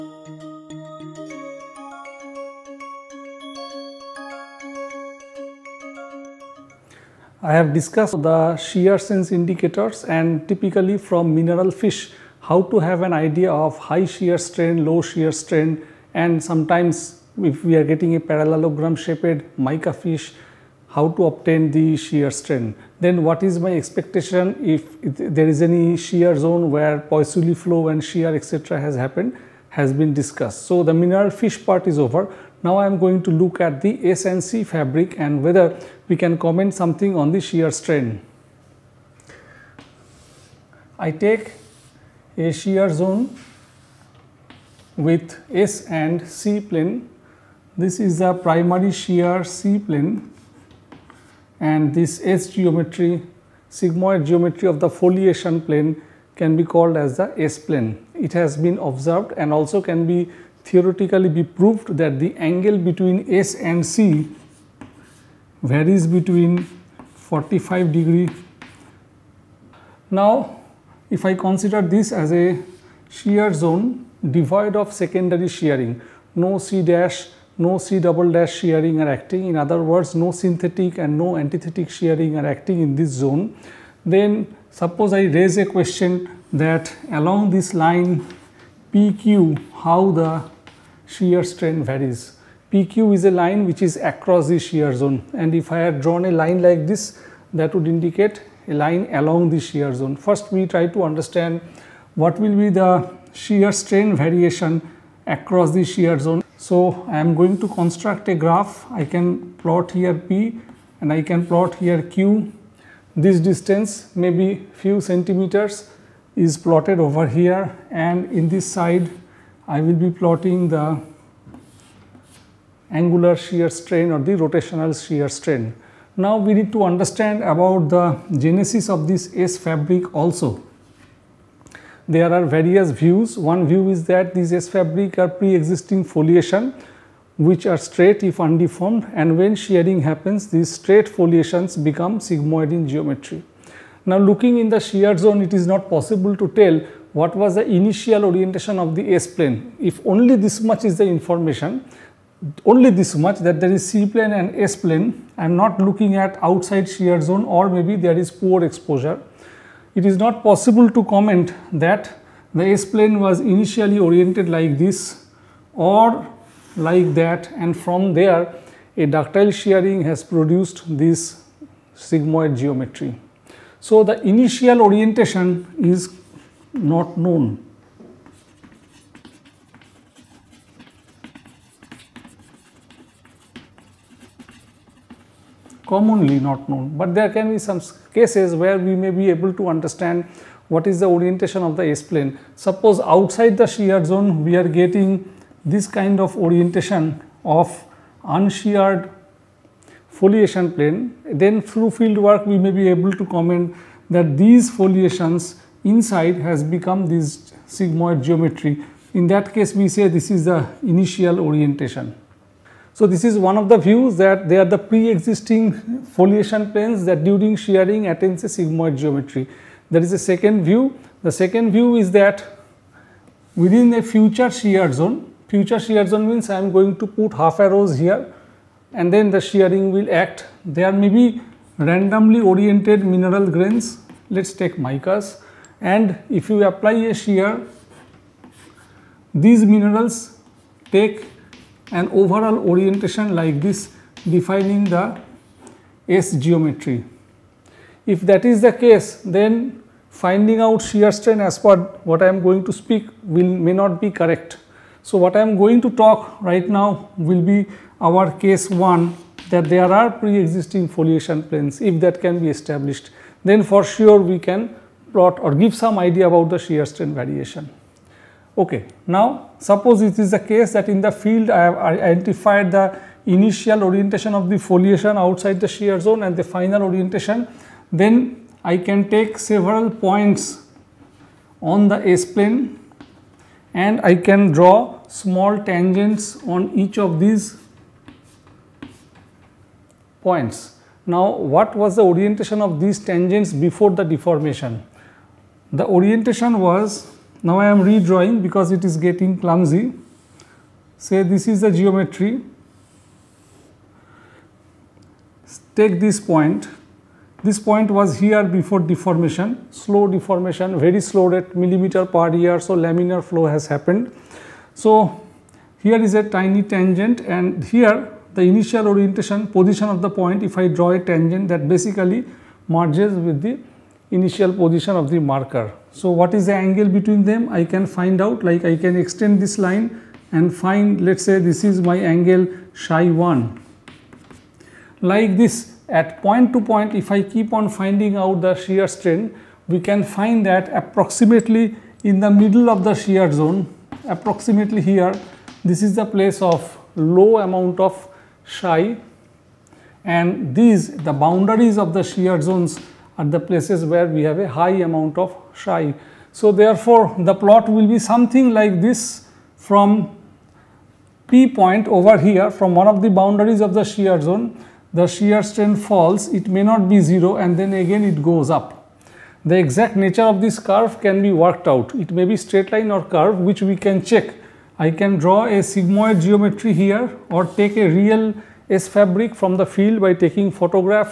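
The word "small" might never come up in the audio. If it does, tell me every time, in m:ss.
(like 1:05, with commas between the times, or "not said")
4:45.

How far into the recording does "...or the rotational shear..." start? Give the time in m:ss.
2:04.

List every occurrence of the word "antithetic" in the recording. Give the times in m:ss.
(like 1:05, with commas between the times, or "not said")
1:21.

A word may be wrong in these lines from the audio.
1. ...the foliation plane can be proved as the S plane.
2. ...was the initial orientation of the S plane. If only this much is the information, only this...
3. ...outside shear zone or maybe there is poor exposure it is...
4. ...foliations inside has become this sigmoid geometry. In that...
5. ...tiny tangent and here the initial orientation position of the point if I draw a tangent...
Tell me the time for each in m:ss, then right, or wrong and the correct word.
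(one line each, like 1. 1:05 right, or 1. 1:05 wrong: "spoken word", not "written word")
1. 0:54 wrong: "called", not "proved"
2. 2:27 right
3. 2:36 right
4. 3:24 right
5. 5:16 right.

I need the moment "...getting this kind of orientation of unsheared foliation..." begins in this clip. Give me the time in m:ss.
3:14.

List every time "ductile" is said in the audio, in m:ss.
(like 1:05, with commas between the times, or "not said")
2:49.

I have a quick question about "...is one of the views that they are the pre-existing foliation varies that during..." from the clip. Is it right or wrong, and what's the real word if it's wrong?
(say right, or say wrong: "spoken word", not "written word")
wrong: "planes", not "varies".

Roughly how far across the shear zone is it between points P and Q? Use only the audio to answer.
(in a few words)
few centimeters.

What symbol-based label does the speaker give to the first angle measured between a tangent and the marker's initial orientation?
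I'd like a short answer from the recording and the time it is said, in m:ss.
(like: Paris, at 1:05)
psi 1, at 5:32.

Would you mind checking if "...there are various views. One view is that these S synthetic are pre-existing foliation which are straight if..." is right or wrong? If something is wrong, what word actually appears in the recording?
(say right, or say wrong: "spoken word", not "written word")
wrong: "fabric", not "synthetic".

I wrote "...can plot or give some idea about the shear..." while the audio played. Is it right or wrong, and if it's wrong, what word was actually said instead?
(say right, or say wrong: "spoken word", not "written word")
right.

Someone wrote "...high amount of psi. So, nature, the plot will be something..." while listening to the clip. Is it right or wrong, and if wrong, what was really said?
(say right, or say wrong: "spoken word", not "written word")
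wrong: "therefore", not "nature".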